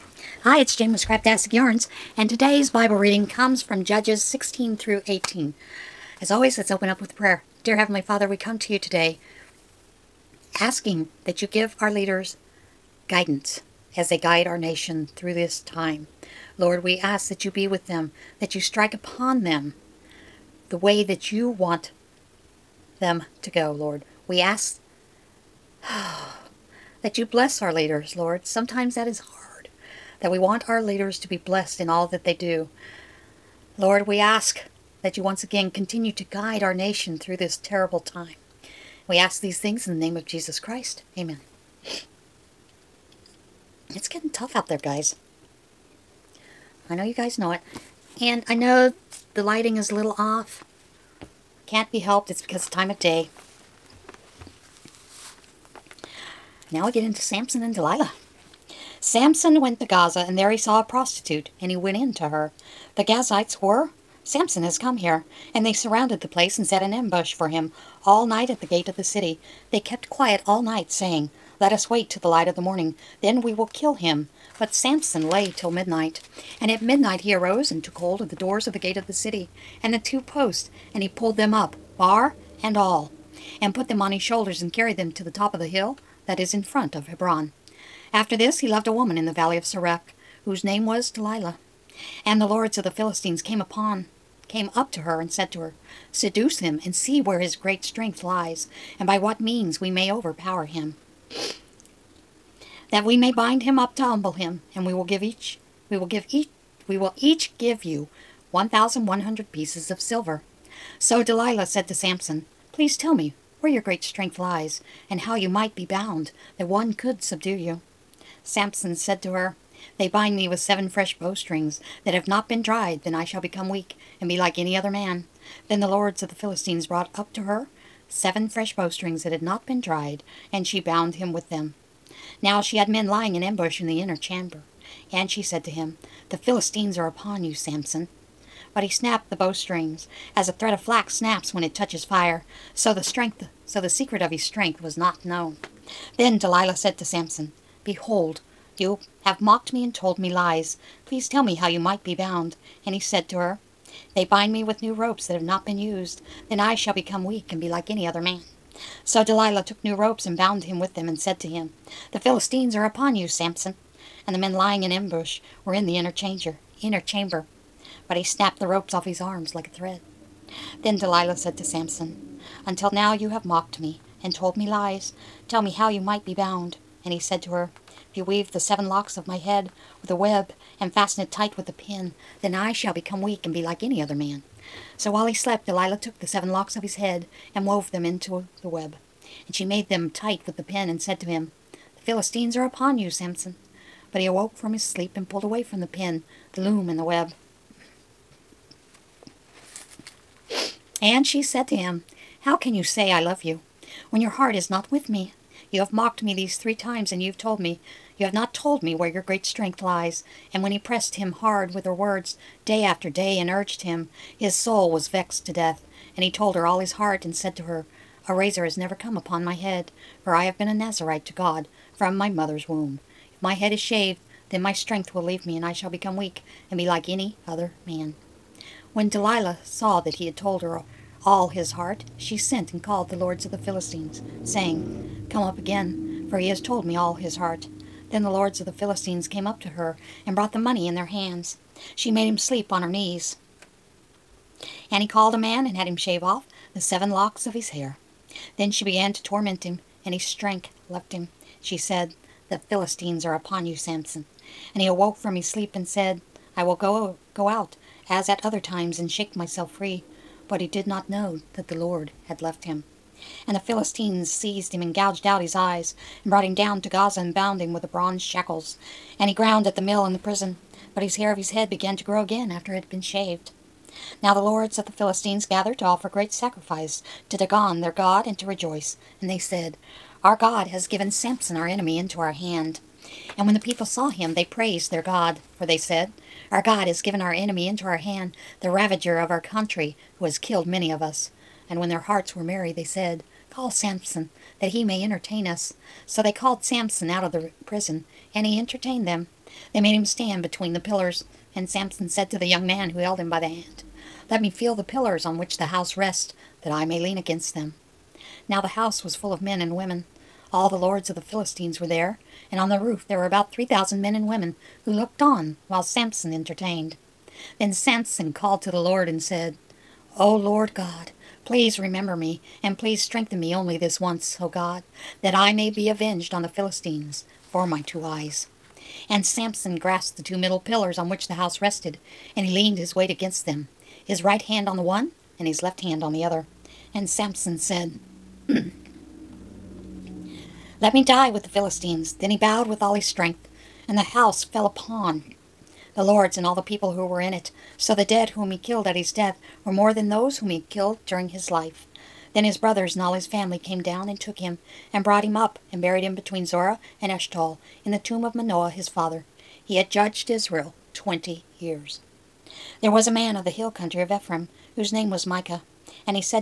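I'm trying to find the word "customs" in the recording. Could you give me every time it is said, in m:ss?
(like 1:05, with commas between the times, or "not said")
not said.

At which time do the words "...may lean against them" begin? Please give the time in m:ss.
5:06.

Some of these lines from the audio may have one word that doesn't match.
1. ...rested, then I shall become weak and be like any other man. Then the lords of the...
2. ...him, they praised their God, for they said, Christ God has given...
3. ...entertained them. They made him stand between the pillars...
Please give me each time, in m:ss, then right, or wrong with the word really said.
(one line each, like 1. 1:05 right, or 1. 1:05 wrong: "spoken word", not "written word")
1. 2:02 wrong: "dried", not "rested"
2. 4:44 wrong: "Our", not "Christ"
3. 4:58 right.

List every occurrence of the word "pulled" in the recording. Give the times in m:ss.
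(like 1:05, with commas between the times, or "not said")
1:21, 3:15.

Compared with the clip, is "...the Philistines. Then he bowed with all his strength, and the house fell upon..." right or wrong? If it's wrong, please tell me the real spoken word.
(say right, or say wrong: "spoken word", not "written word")
right.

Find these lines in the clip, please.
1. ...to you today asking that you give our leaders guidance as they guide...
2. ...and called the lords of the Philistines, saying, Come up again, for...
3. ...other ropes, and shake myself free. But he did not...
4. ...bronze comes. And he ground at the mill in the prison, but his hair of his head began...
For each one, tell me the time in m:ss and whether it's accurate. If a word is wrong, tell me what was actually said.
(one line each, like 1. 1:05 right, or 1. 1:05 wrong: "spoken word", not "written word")
1. 0:08 right
2. 3:52 right
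3. 4:18 wrong: "times", not "ropes"
4. 4:27 wrong: "shackles", not "comes".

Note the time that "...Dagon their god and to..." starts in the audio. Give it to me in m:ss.
4:37.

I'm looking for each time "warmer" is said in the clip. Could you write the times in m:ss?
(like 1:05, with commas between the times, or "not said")
not said.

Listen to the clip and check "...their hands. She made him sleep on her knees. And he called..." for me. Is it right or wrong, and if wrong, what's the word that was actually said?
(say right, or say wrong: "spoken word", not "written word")
right.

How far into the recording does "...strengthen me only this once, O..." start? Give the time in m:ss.
5:23.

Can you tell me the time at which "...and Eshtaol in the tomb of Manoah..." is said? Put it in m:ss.
5:57.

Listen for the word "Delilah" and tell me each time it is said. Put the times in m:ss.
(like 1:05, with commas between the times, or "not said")
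0:57, 1:31, 1:51, 2:26, 2:39, 2:50, 3:05, 3:49.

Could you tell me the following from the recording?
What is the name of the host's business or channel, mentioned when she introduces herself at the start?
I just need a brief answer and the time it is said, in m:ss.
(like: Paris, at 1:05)
Scraptastic Yarns, at 0:00.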